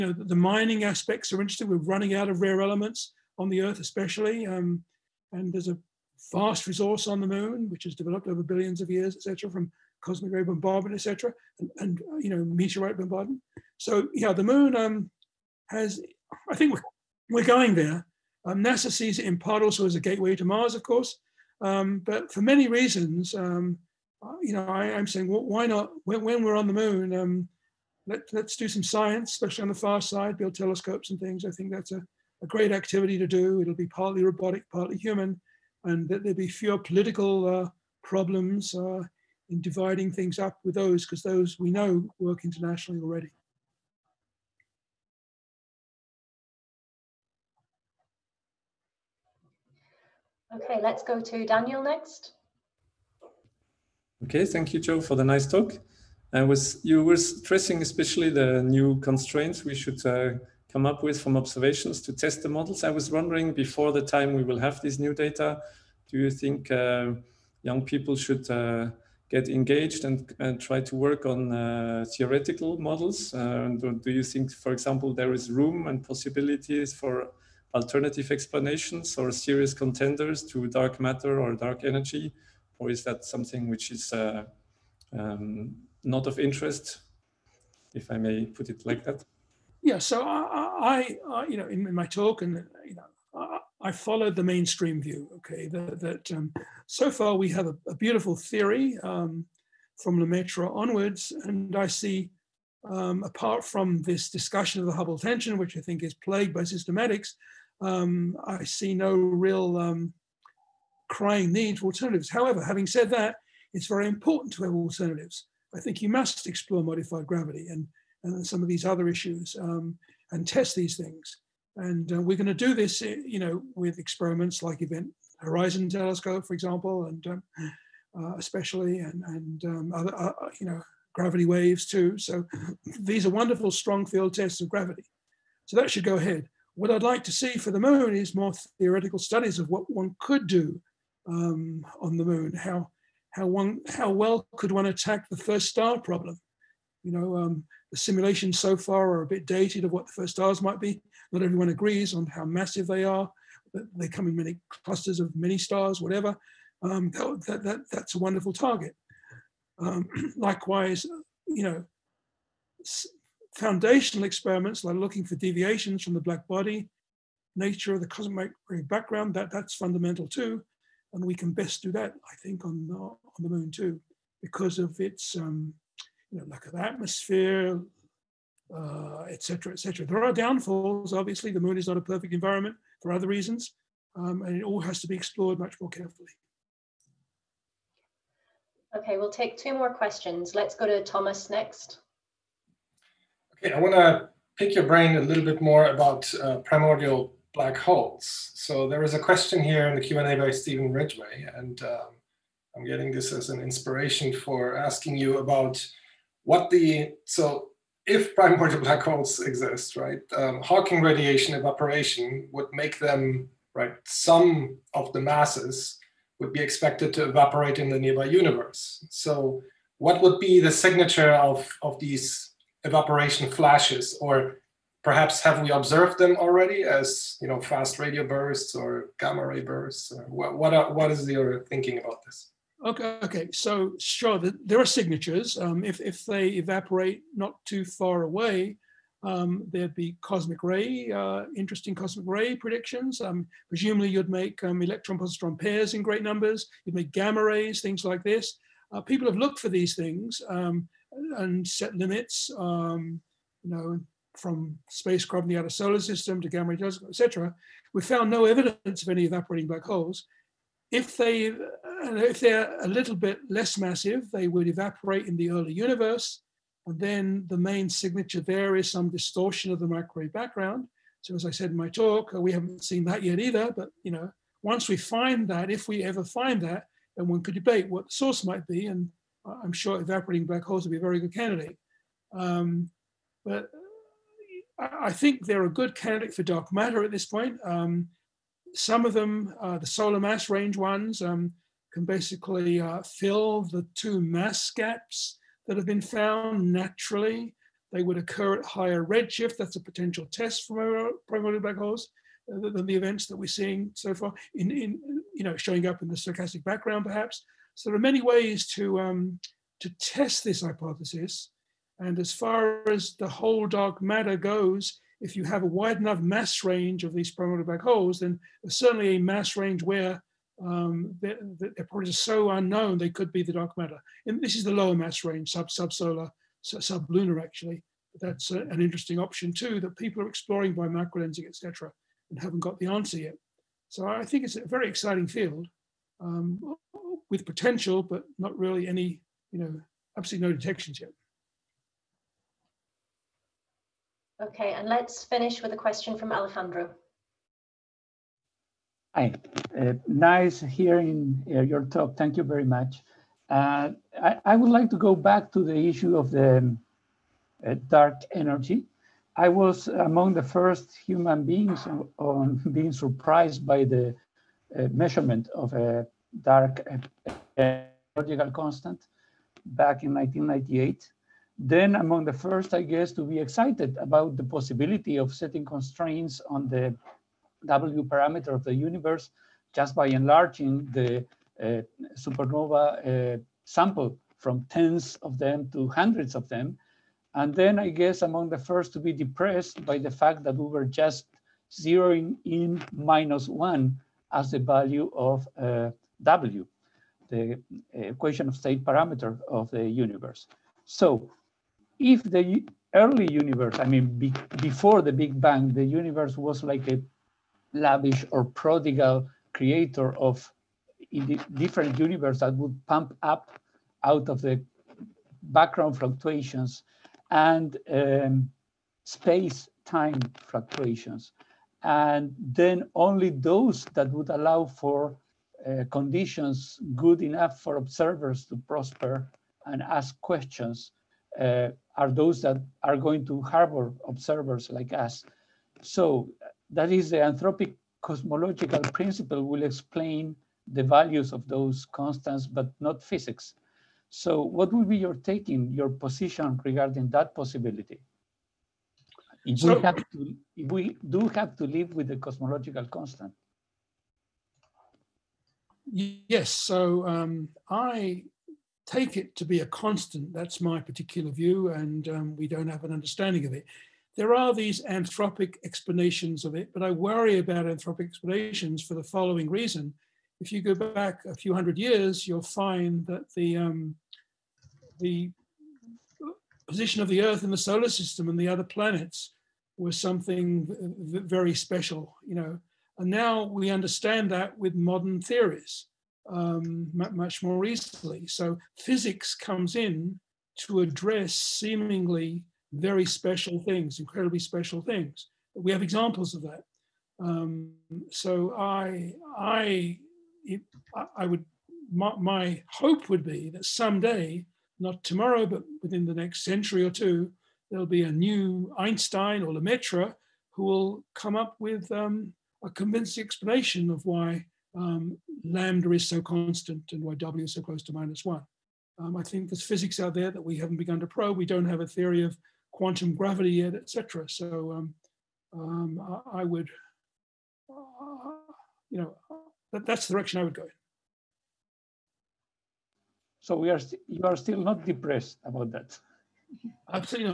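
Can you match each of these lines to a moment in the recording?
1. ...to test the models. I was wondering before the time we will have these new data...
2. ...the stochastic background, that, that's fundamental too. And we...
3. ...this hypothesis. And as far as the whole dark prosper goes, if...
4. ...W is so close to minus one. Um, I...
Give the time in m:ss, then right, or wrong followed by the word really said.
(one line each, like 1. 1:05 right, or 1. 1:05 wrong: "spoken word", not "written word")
1. 1:02 right
2. 2:48 wrong: "cosmic", not "stochastic"
3. 5:10 wrong: "matter", not "prosper"
4. 8:37 right.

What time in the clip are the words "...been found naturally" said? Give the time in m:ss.
4:55.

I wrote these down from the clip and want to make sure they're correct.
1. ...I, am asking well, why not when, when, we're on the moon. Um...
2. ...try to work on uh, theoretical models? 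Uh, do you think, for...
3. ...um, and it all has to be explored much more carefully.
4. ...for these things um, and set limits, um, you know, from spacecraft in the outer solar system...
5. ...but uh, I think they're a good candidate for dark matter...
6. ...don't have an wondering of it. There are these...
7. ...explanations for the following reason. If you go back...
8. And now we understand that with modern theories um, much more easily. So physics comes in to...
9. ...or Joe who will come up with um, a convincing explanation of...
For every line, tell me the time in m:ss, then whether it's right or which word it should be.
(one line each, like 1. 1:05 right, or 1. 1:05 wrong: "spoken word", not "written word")
1. 0:24 wrong: "saying", not "asking"
2. 1:10 right
3. 3:04 right
4. 4:09 right
5. 4:43 right
6. 7:42 wrong: "understanding", not "wondering"
7. 7:48 right
8. 8:02 right
9. 8:29 wrong: "Lemaitre", not "Joe".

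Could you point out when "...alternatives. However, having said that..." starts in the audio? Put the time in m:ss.
1:51.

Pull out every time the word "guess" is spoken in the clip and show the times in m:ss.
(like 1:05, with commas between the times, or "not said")
6:12, 6:27.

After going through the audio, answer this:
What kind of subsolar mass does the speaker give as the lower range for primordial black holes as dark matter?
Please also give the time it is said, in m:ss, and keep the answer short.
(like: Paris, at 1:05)
lunar, at 5:27.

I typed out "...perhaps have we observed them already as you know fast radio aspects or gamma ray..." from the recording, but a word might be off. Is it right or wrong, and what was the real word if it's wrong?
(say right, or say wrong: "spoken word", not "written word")
wrong: "bursts", not "aspects".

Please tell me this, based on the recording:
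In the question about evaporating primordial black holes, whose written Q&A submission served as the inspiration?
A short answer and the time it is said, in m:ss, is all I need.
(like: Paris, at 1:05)
Stephen Ridgway, at 3:20.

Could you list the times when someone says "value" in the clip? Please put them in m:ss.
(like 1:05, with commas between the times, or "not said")
6:34, 7:20.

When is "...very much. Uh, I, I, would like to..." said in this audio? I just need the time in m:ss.
5:52.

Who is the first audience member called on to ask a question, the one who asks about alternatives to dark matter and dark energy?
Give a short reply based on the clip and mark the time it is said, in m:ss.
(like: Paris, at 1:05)
Daniel, at 0:51.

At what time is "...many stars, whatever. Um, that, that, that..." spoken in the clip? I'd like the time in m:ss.
2:35.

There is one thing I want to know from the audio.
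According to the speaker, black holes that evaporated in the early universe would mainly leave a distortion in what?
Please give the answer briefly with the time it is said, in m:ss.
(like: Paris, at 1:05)
the microwave background, at 4:29.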